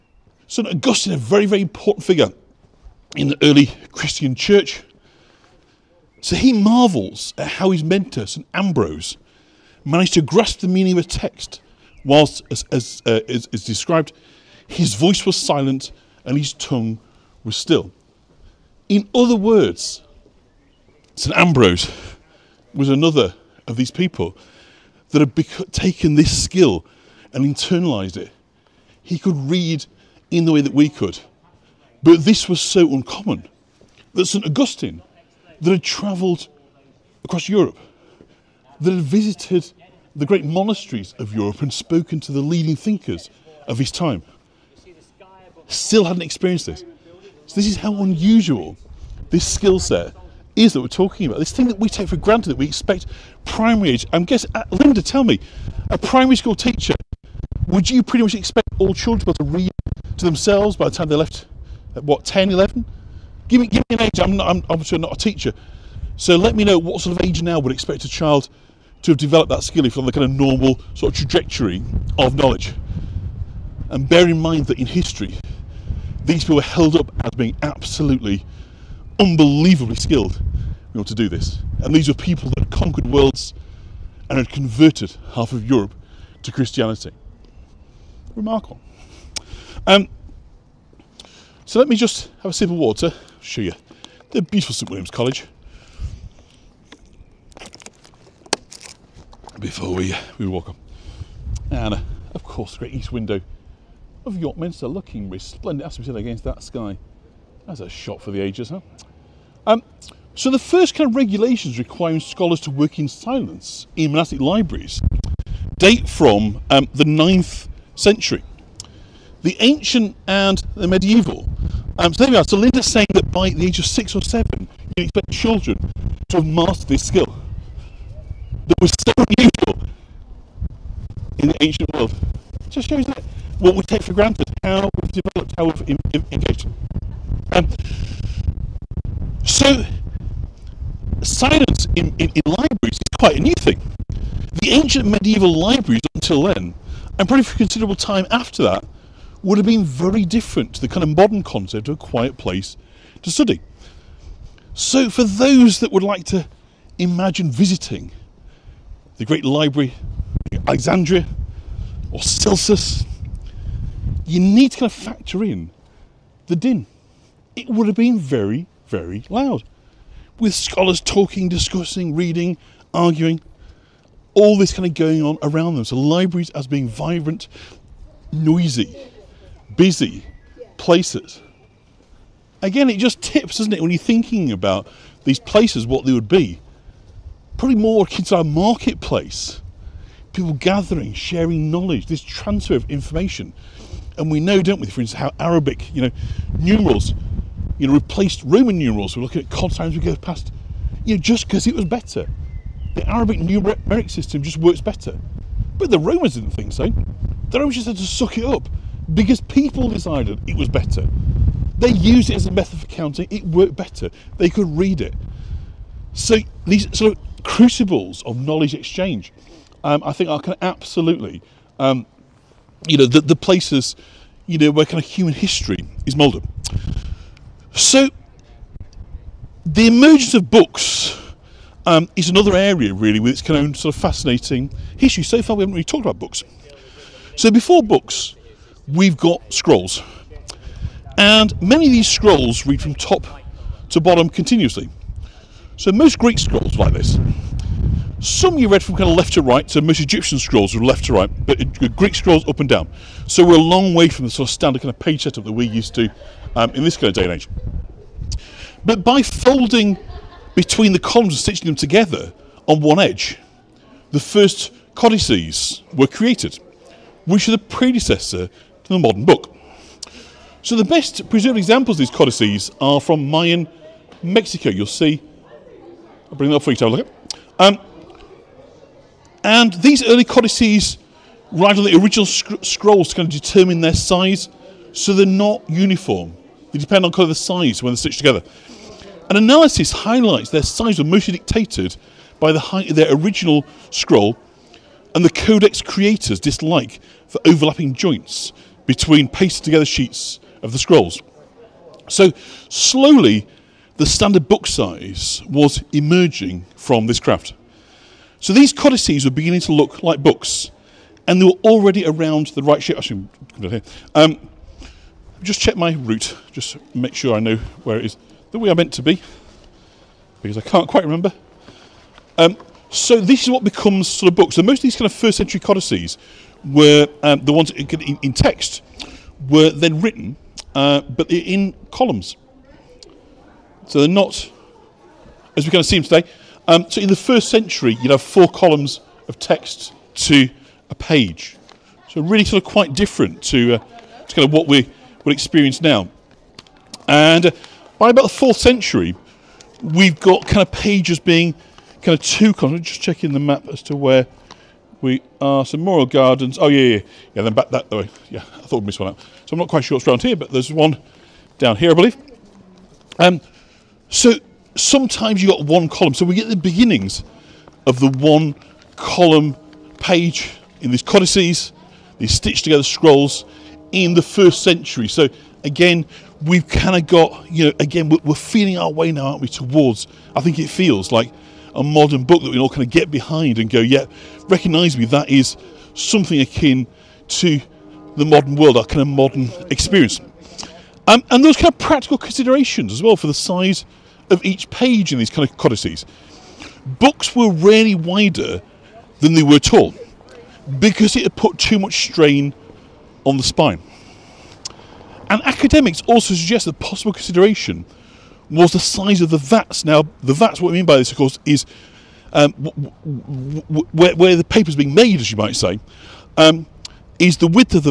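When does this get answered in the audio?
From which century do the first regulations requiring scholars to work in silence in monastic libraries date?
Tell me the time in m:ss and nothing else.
1:57.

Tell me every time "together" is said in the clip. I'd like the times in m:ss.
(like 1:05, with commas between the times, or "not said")
4:21, 4:48, 4:59, 6:12.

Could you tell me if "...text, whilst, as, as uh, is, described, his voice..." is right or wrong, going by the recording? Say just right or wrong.
right.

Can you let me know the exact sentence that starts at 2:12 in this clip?
It just shows that what we take for granted, how we've developed, how we've engaged.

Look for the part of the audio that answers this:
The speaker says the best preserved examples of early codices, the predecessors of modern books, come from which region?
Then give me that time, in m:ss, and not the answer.
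4:33.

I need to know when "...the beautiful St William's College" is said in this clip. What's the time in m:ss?
1:34.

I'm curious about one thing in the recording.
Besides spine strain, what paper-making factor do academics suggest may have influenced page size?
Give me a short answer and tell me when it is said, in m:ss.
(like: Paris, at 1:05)
the size of the vats, at 6:48.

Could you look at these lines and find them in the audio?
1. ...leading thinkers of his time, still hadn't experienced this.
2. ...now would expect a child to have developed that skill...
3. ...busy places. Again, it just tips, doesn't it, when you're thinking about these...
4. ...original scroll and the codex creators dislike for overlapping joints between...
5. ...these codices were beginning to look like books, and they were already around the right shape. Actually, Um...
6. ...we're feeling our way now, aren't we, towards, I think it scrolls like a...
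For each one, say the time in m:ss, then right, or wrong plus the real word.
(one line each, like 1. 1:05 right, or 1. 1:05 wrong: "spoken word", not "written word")
1. 0:42 right
2. 1:07 right
3. 2:59 right
4. 4:53 right
5. 5:08 right
6. 6:18 wrong: "feels", not "scrolls".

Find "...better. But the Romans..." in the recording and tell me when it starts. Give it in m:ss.
3:24.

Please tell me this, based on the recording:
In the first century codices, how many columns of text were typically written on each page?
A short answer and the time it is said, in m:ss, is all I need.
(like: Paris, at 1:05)
4, at 5:38.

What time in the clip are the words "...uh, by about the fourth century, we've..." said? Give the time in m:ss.
5:47.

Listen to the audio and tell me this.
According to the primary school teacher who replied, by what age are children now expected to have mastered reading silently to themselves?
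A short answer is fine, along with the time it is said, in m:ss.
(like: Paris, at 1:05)
6 or 7, at 2:03.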